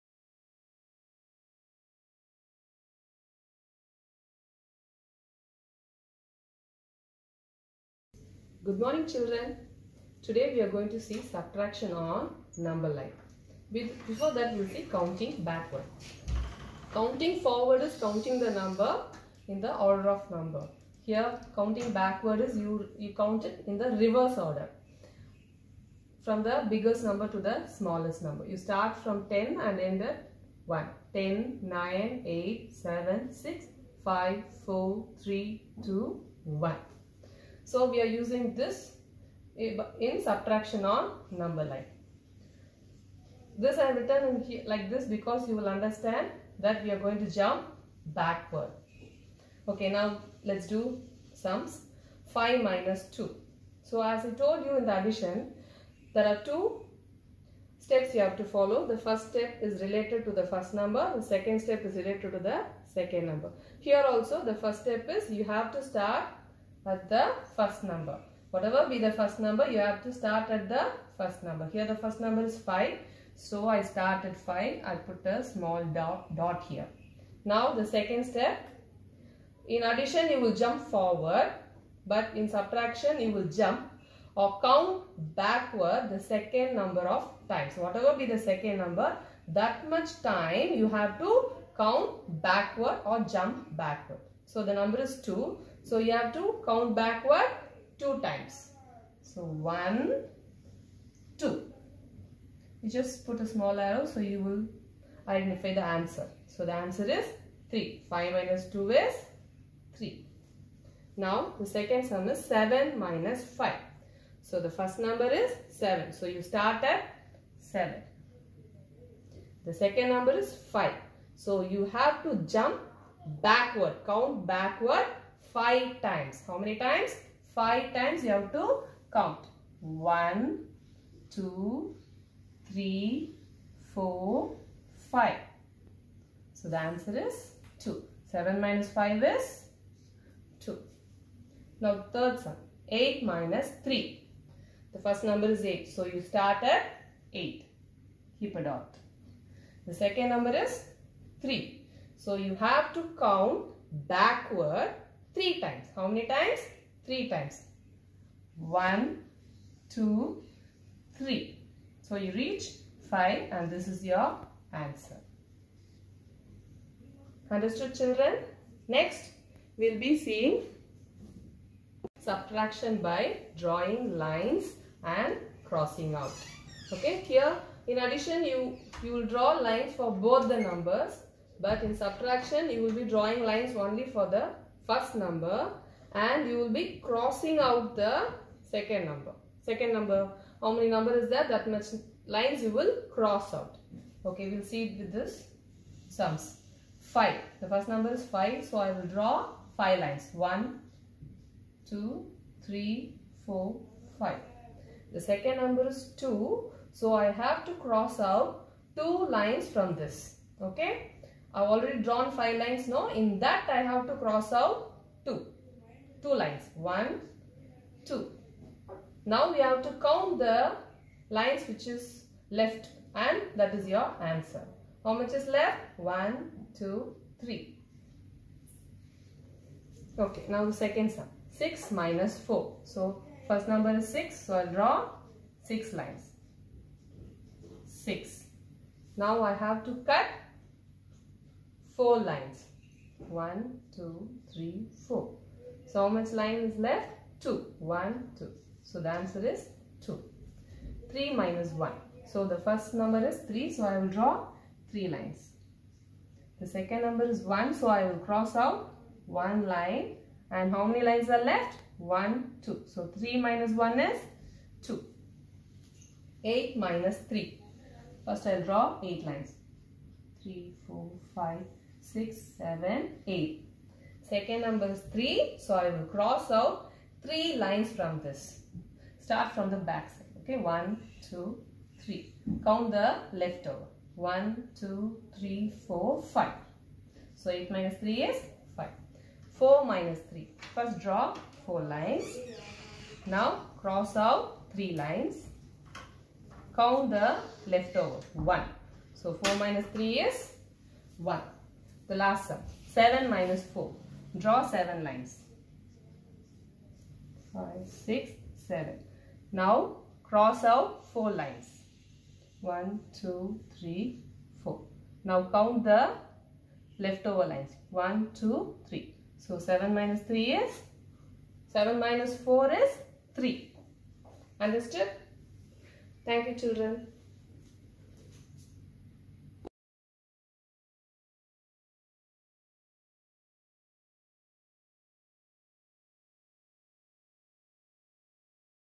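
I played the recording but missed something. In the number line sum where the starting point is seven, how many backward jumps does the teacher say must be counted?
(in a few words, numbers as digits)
5.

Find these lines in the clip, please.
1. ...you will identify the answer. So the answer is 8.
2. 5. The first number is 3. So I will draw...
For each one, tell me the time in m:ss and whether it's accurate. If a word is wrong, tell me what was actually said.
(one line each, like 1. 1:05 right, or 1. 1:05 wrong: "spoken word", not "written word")
1. 1:44 wrong: "3", not "8"
2. 3:16 wrong: "5", not "3".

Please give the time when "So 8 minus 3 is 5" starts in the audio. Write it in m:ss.
4:47.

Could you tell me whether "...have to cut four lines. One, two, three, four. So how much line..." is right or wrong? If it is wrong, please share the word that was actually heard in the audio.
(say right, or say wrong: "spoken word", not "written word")
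right.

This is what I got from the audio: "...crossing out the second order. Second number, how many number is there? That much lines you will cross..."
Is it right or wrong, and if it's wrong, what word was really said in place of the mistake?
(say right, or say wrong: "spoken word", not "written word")
wrong: "number", not "order".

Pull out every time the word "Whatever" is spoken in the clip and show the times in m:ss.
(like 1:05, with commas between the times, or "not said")
1:08, 1:27.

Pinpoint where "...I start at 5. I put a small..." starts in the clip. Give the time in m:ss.
1:13.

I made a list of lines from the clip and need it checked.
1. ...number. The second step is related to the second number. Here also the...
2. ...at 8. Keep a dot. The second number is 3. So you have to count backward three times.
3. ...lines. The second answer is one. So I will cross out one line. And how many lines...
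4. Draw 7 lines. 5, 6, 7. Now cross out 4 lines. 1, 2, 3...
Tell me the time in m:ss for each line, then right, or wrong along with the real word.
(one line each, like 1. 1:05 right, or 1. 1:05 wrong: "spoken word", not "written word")
1. 1:00 right
2. 2:26 right
3. 4:15 wrong: "number", not "answer"
4. 5:04 right.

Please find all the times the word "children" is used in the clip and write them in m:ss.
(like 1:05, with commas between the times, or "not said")
0:09, 2:47, 5:26.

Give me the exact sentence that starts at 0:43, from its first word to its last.
This I have written here, like this because you will understand that we are going to jump backward.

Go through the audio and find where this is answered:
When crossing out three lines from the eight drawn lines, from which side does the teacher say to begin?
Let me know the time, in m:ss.
4:39.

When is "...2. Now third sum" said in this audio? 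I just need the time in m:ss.
2:20.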